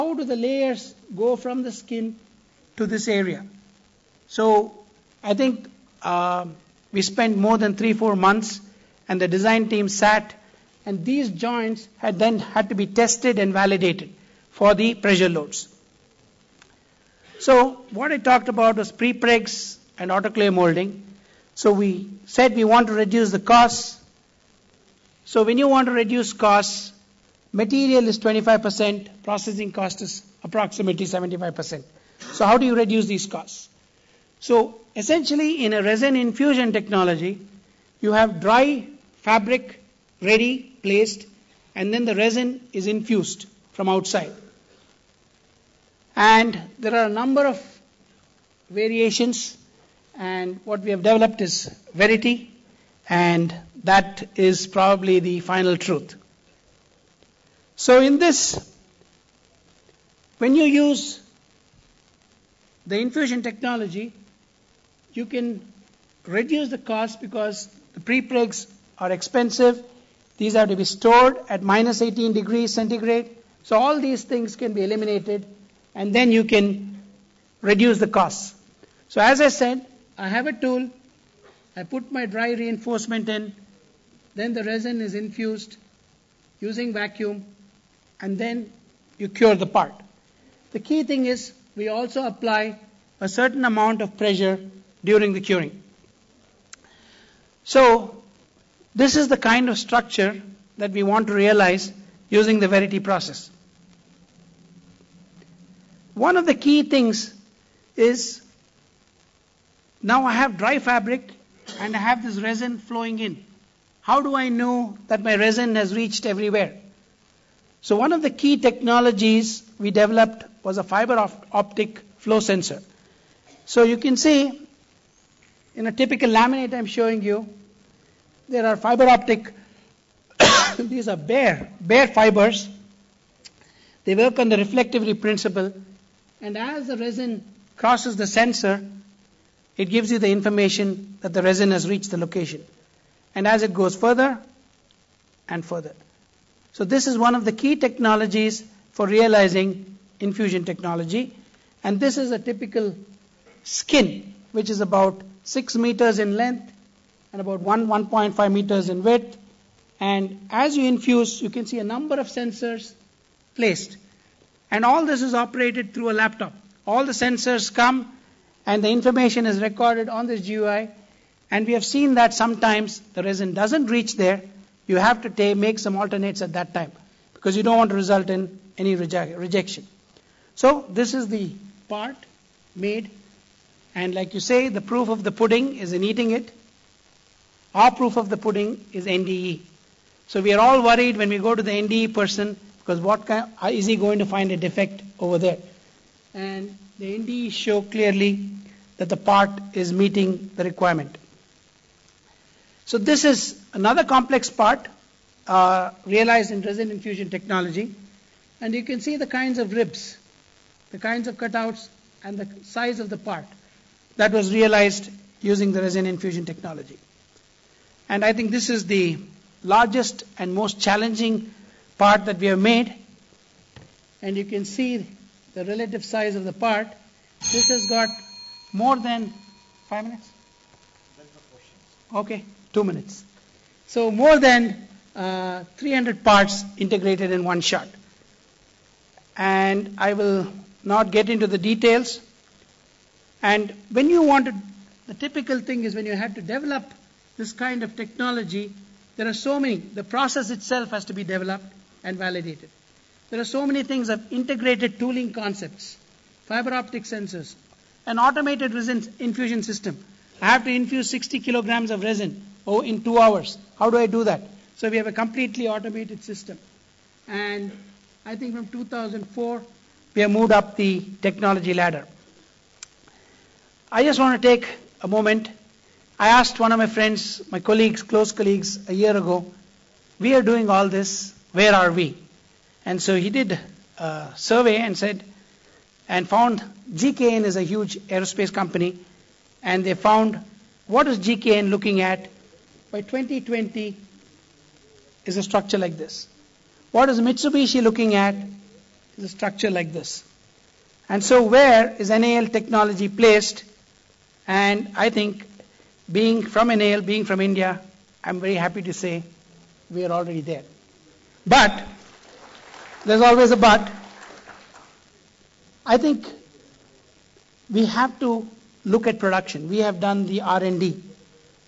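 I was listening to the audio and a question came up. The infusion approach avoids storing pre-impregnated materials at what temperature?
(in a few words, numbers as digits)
-18 degrees centigrade.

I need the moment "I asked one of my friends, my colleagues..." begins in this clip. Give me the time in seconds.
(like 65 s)
276 s.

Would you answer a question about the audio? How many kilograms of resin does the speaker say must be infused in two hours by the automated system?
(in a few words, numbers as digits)
60 kilograms.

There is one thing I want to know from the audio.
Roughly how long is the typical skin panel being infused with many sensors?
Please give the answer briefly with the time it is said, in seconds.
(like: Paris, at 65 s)
6 meters, at 155 s.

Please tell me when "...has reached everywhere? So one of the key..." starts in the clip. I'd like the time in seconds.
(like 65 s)
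115 s.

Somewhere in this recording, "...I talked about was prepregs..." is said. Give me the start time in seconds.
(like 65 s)
18 s.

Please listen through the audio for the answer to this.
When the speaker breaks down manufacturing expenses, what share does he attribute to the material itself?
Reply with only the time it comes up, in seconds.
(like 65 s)
27 s.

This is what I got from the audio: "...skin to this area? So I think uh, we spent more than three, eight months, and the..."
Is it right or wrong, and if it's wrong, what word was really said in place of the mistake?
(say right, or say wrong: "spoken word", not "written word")
wrong: "four", not "eight".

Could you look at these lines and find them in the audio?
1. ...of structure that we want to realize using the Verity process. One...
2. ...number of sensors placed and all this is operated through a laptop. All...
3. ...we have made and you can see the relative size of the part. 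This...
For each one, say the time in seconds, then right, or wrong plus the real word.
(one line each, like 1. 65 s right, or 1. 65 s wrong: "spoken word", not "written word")
1. 99 s right
2. 161 s right
3. 222 s right.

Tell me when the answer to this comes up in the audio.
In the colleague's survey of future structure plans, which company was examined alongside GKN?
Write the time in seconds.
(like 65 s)
297 s.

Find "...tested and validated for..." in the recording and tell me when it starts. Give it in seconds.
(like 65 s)
12 s.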